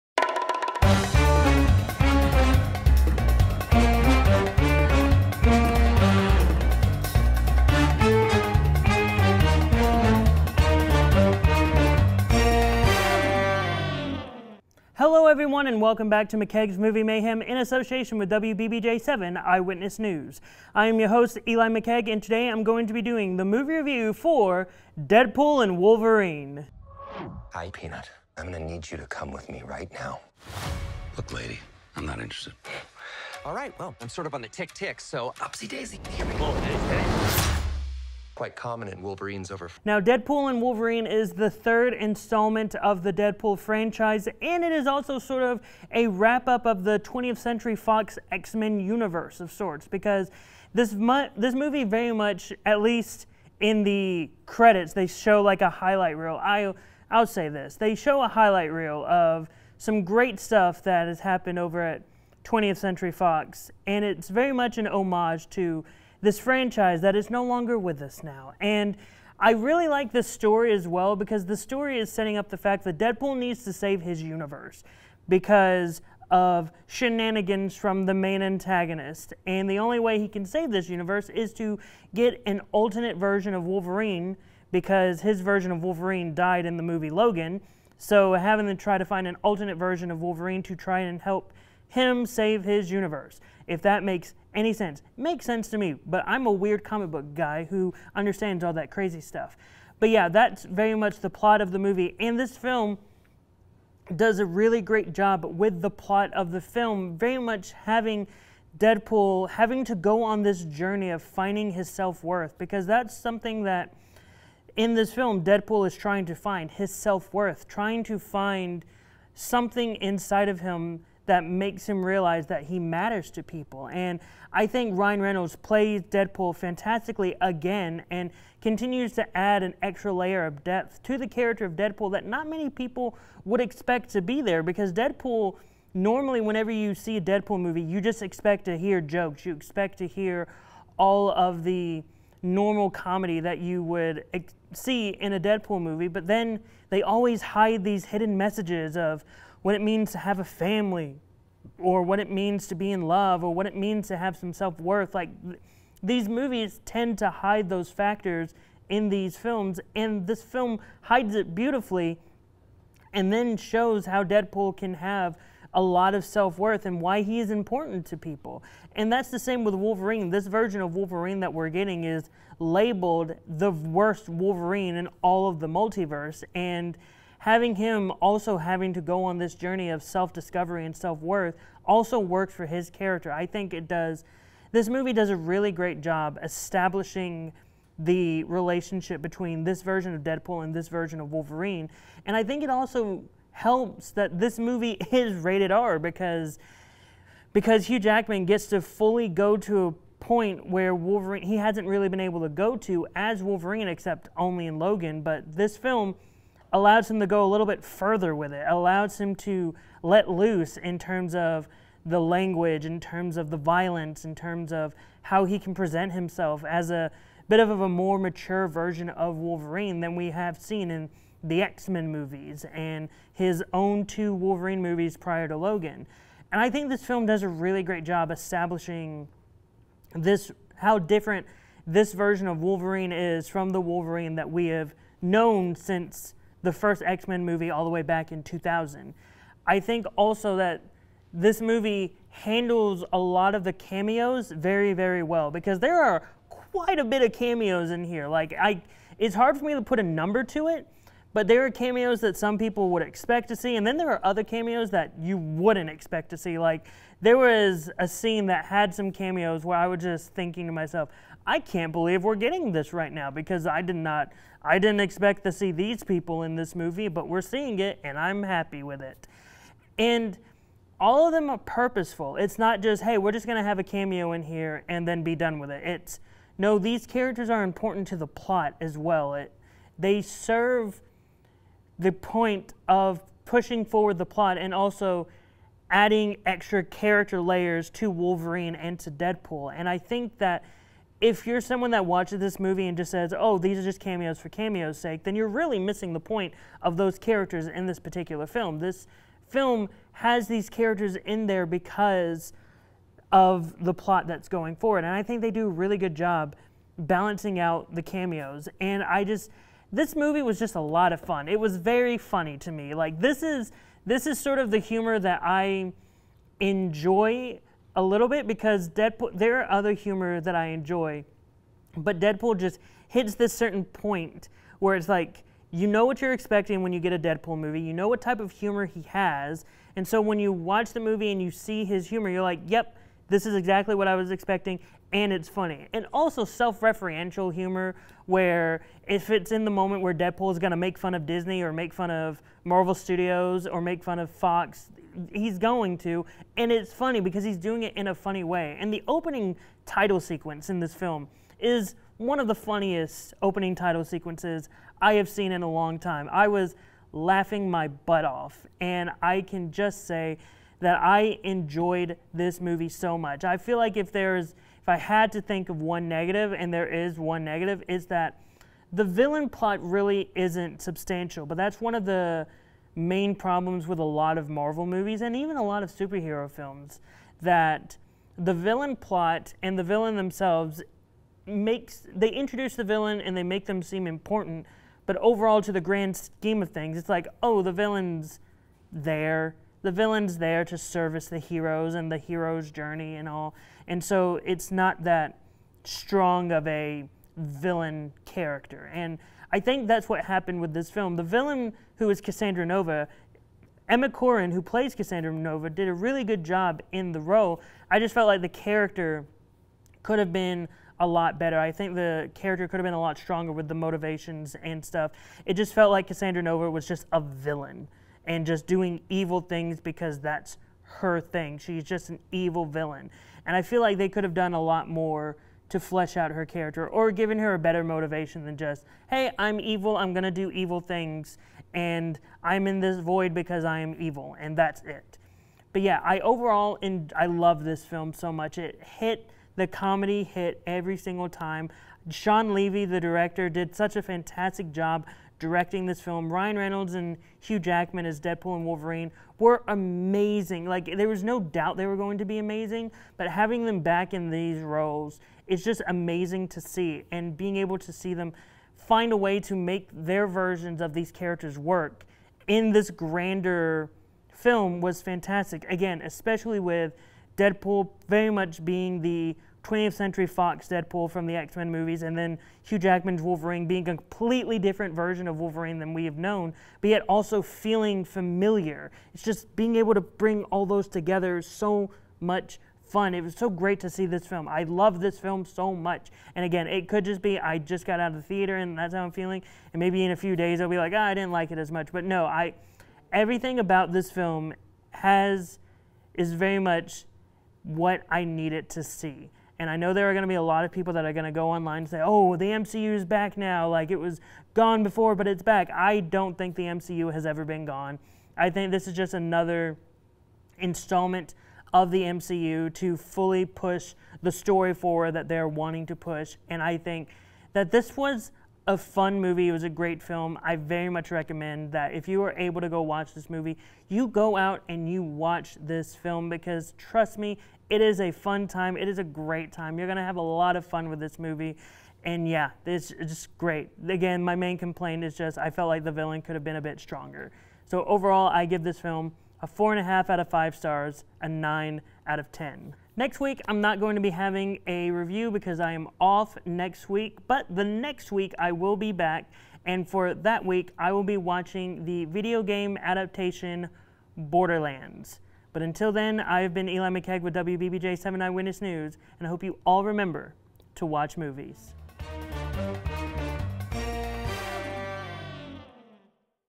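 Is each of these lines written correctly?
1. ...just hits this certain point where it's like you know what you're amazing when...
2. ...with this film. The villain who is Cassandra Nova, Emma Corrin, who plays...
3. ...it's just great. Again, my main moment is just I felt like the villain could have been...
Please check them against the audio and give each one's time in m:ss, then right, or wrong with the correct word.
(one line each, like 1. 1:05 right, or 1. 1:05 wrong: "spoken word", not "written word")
1. 5:22 wrong: "expecting", not "amazing"
2. 6:40 right
3. 8:52 wrong: "complaint", not "moment".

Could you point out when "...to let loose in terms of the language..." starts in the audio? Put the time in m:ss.
3:29.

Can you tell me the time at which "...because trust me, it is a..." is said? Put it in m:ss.
8:46.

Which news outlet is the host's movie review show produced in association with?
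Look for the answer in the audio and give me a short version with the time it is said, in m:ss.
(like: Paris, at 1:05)
WBBJ7 Eyewitness News, at 0:18.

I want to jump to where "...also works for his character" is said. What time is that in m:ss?
3:01.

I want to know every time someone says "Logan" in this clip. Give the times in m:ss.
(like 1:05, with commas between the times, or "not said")
1:27, 3:24, 3:45.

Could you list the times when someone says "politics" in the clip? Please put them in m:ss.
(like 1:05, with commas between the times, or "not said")
not said.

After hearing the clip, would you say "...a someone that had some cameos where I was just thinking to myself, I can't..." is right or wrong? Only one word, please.
wrong.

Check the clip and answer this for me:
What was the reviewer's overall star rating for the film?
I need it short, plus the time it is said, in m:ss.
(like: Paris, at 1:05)
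4.5 out of 5, at 8:59.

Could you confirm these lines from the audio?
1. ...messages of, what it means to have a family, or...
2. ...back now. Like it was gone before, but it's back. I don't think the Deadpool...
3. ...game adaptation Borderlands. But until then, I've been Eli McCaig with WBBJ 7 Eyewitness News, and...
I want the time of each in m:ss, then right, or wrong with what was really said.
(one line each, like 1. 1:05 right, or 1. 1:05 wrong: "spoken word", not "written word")
1. 2:28 right
2. 8:23 wrong: "MCU", not "Deadpool"
3. 9:12 right.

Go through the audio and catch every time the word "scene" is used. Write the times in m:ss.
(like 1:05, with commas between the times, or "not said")
4:18.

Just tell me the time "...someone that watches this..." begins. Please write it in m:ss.
4:51.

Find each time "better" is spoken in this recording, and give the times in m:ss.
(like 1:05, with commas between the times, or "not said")
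6:51, 7:07.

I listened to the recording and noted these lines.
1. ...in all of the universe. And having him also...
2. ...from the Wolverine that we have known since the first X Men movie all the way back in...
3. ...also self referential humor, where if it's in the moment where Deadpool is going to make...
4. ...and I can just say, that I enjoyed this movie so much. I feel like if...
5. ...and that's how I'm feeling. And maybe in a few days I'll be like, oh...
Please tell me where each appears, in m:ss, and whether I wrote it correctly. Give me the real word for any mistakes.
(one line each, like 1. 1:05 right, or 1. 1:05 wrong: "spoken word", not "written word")
1. 2:54 wrong: "multiverse", not "universe"
2. 3:53 right
3. 5:36 right
4. 5:58 right
5. 8:08 right.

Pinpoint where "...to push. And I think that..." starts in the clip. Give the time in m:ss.
8:35.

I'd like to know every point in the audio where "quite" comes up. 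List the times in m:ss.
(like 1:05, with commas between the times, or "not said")
0:38, 4:06.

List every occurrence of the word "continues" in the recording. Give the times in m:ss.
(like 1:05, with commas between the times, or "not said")
2:08.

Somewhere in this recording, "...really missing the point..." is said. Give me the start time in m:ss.
4:55.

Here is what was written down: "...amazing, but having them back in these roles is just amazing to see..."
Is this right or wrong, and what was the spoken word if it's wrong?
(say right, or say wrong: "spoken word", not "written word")
right.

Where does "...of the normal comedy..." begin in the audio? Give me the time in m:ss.
2:21.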